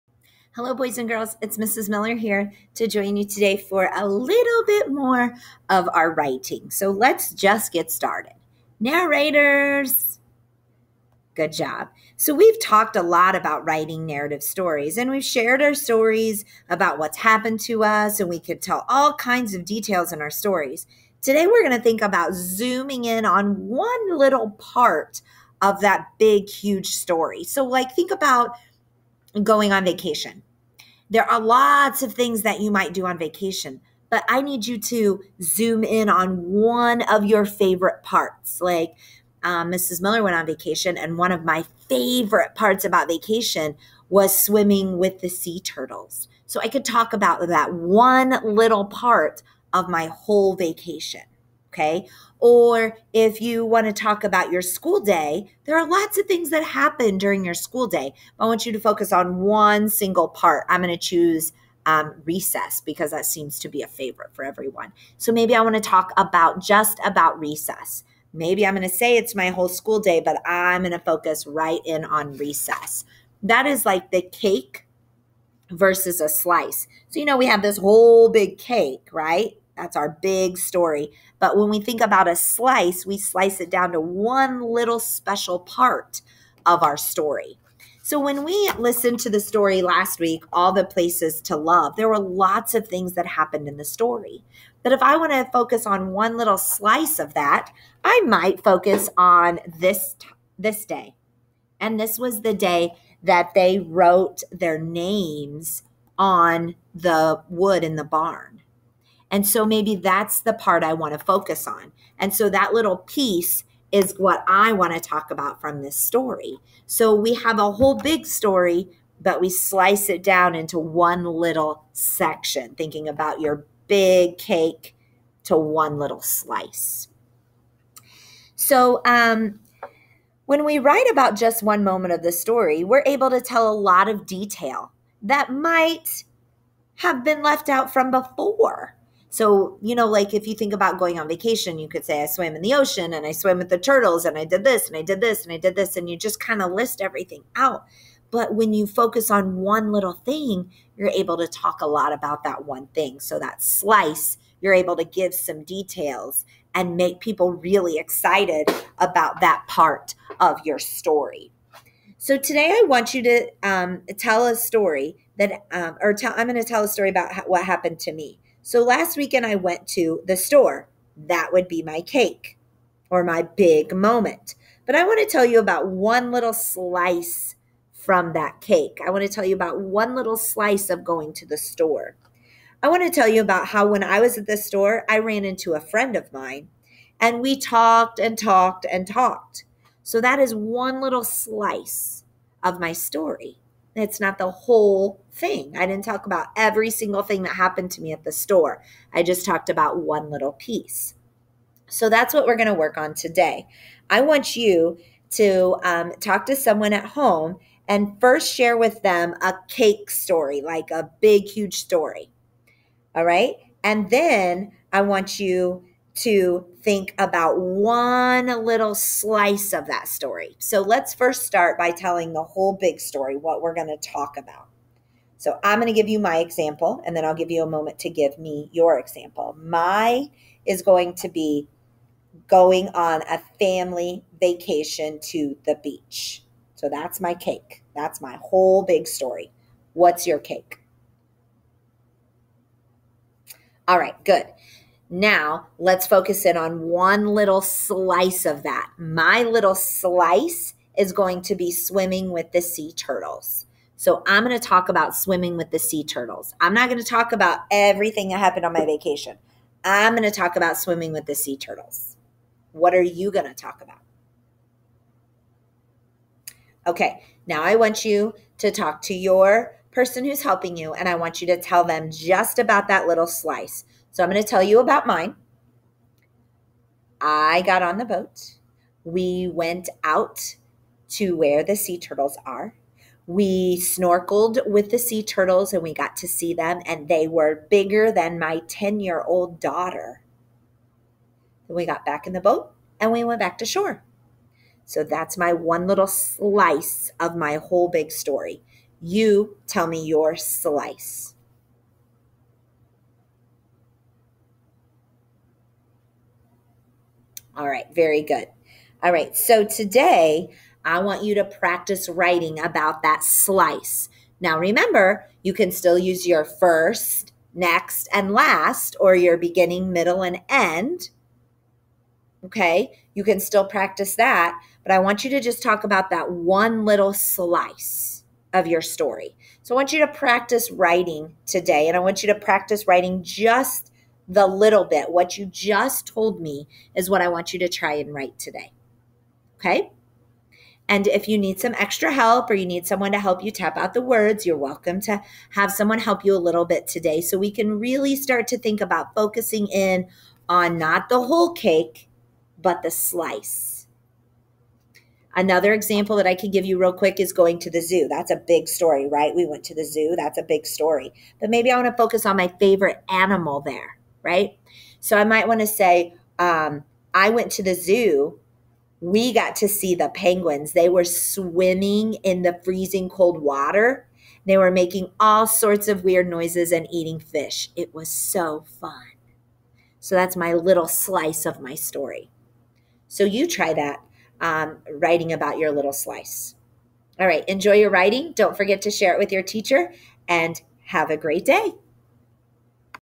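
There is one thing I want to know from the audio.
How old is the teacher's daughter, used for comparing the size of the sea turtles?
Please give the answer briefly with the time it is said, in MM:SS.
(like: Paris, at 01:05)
10, at 04:48.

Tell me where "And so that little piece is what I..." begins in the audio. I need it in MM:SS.
01:52.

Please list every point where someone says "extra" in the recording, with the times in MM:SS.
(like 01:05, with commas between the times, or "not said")
05:41.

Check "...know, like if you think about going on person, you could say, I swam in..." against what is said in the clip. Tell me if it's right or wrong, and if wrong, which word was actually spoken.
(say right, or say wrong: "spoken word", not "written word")
wrong: "vacation", not "person".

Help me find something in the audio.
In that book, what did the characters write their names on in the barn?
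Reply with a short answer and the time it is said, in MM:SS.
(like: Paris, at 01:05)
The wood, at 01:46.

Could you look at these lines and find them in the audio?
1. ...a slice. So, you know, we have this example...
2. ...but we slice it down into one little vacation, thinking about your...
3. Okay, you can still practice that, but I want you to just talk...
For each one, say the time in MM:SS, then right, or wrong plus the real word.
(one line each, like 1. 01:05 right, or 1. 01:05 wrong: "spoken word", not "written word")
1. 01:16 wrong: "whole", not "example"
2. 01:59 wrong: "section", not "vacation"
3. 05:22 right.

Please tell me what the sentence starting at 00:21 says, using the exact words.
Today, we're going to think about zooming in on one little part of that big, huge story.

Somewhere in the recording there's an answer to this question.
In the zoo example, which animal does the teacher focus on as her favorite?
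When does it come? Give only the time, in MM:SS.
06:10.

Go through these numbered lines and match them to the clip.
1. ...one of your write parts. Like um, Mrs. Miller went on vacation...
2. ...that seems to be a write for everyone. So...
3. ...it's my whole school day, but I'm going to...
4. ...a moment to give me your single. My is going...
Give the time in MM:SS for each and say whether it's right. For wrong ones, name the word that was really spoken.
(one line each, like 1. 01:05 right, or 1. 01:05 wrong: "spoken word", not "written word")
1. 00:36 wrong: "favorite", not "write"
2. 01:03 wrong: "favorite", not "write"
3. 01:09 right
4. 03:47 wrong: "example", not "single".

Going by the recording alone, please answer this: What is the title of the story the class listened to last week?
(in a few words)
All the Places to Love.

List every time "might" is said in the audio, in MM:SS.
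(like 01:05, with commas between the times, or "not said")
00:32, 01:38, 02:15, 06:05.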